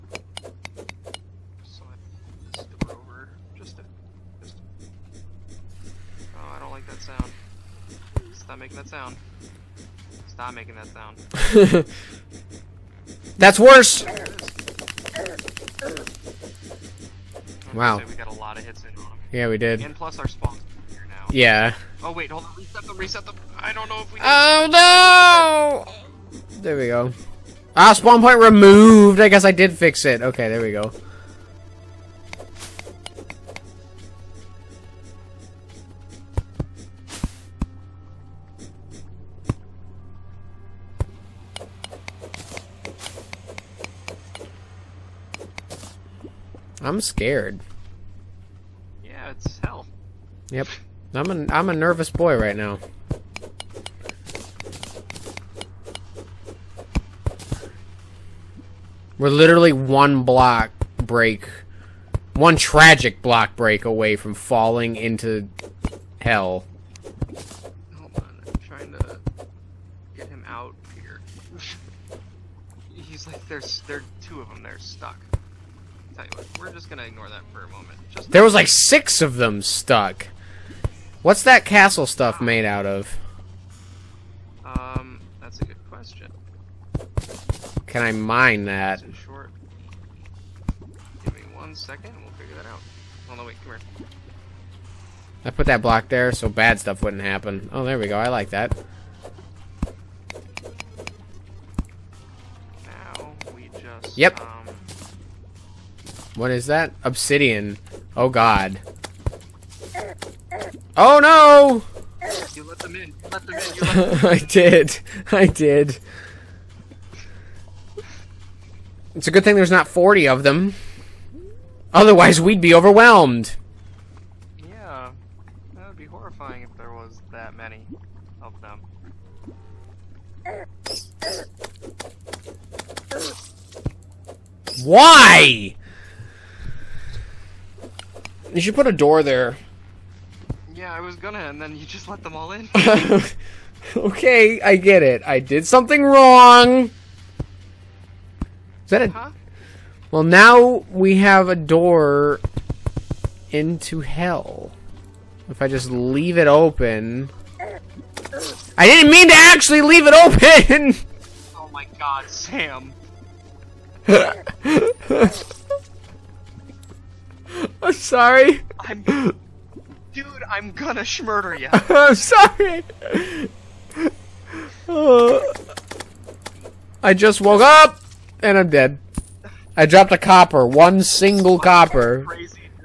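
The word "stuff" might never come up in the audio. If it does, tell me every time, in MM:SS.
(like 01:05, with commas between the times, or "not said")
01:22, 01:36.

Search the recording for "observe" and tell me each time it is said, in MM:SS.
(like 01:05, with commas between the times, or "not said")
not said.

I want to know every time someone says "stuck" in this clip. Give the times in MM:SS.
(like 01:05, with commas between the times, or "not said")
01:14, 01:19.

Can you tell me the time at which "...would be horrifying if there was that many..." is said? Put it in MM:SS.
02:05.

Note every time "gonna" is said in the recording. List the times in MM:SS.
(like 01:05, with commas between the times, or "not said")
01:16, 02:21, 02:50.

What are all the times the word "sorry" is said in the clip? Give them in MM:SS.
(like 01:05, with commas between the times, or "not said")
02:47, 02:52.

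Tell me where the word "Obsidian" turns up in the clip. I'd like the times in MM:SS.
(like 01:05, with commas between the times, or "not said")
01:47.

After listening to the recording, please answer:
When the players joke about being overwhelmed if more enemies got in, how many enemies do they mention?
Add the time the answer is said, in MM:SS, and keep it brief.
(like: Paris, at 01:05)
40, at 01:59.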